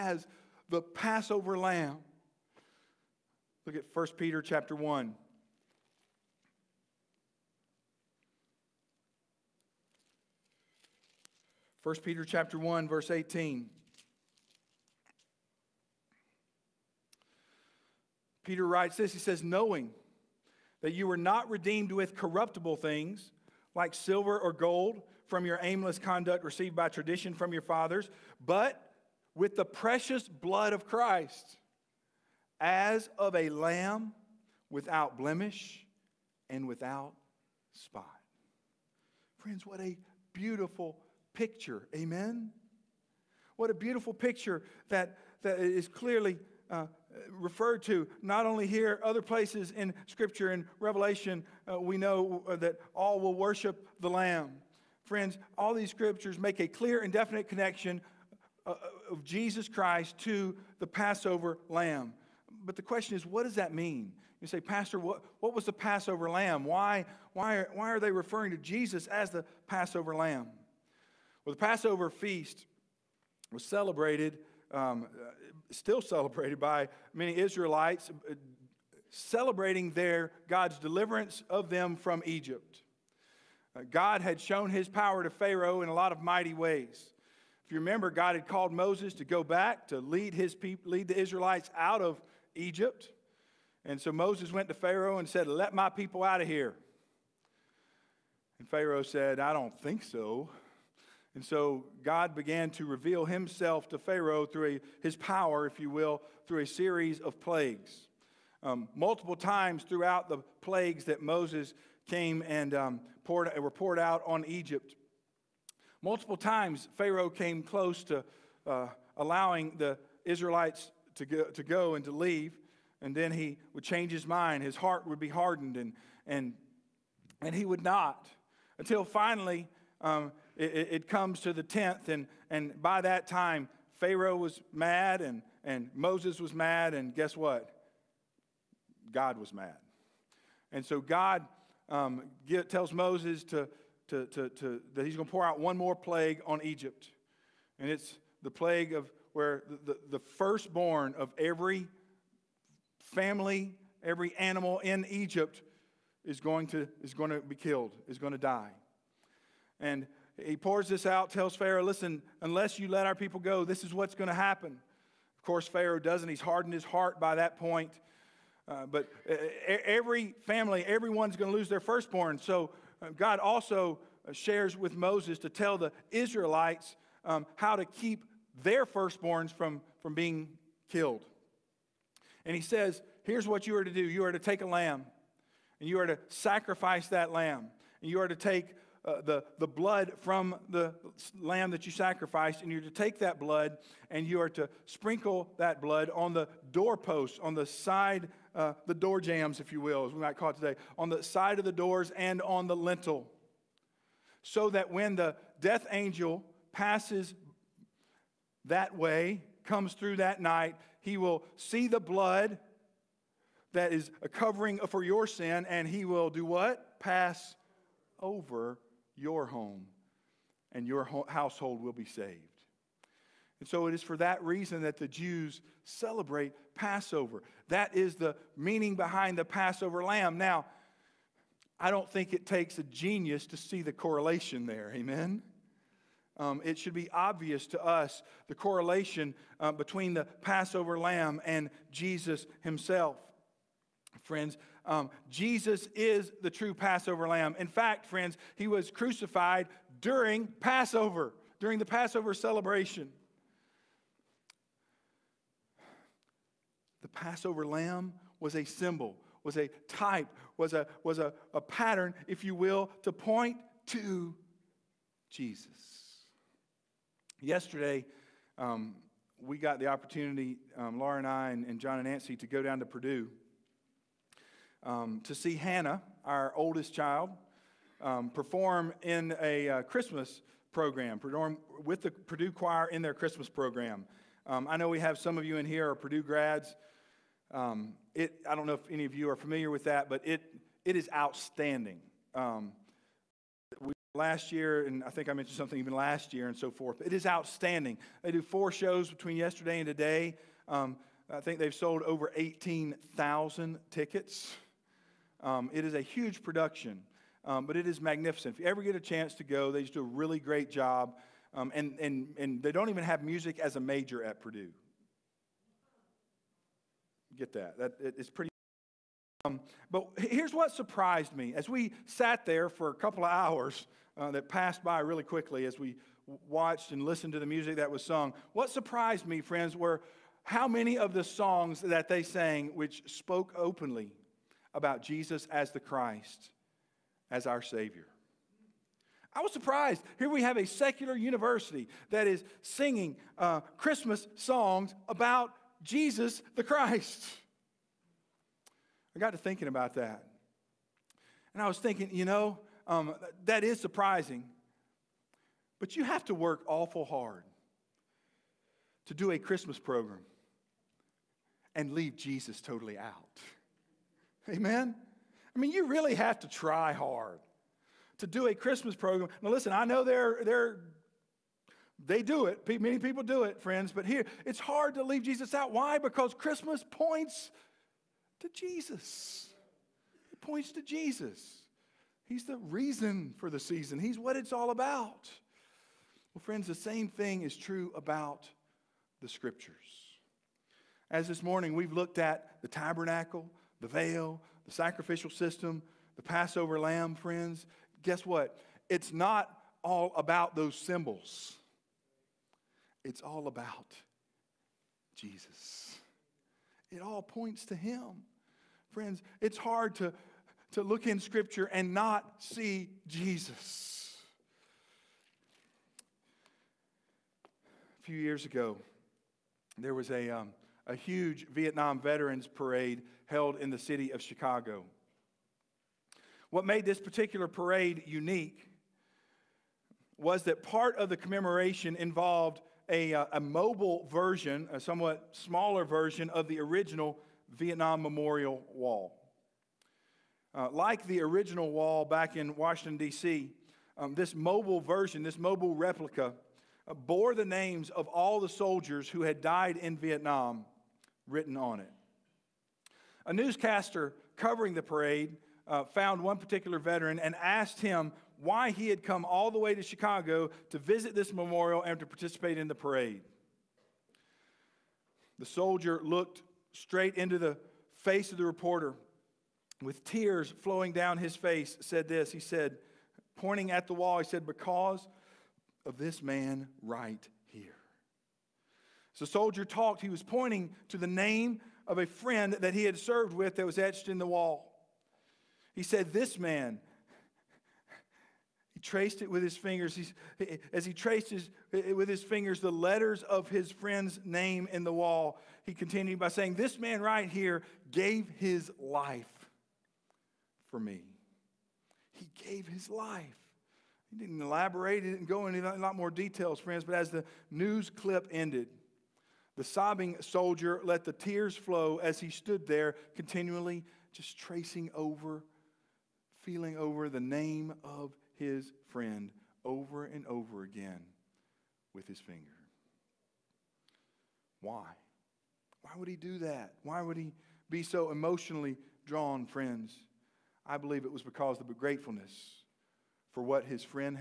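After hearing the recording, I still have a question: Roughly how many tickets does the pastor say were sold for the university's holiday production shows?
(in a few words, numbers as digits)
18,000.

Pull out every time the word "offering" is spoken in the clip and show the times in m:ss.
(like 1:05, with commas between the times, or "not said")
not said.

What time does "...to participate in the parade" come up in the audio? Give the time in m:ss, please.
7:41.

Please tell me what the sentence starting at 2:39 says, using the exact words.
And he pours this out, tells Pharaoh, Listen, unless you let our people go, this is what's going to happen.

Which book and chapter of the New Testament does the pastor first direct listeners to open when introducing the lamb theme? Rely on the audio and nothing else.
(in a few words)
1 Peter chapter 1.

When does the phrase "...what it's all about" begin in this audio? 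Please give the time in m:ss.
6:24.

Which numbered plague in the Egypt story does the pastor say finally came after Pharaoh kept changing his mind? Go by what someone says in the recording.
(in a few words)
10th.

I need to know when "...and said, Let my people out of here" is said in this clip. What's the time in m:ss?
1:35.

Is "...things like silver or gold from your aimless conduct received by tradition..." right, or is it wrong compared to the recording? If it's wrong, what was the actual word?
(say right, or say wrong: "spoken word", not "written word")
right.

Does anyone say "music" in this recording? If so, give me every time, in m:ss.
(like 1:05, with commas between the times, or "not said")
5:13, 5:27.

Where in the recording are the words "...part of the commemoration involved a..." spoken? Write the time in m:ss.
7:10.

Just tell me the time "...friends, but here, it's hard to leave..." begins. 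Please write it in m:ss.
6:13.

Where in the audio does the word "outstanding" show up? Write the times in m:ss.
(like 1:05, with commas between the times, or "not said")
4:51, 4:57.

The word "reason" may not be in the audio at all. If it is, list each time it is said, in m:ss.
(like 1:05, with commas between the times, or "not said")
3:44, 6:22.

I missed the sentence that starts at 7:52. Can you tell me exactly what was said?
He said, pointing at the wall, he said, Because of this man right here.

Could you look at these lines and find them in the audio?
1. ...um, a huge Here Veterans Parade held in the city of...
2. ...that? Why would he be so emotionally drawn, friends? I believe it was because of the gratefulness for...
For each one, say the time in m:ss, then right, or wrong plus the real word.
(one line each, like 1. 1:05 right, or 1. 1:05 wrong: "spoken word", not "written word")
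1. 7:00 wrong: "Vietnam", not "Here"
2. 8:46 right.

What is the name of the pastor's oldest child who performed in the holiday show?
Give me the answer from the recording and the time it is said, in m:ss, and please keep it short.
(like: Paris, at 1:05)
Hannah, at 4:35.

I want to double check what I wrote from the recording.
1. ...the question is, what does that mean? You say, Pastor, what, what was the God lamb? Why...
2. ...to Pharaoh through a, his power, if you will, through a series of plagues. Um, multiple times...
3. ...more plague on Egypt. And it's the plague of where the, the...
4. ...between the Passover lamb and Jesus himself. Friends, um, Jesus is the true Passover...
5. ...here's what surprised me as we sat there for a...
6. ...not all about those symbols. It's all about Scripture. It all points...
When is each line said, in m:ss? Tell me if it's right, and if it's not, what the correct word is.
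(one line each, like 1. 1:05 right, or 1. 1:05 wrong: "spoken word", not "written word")
1. 1:02 wrong: "Passover", not "God"
2. 1:43 right
3. 2:25 right
4. 3:59 right
5. 5:20 right
6. 6:39 wrong: "Jesus", not "Scripture".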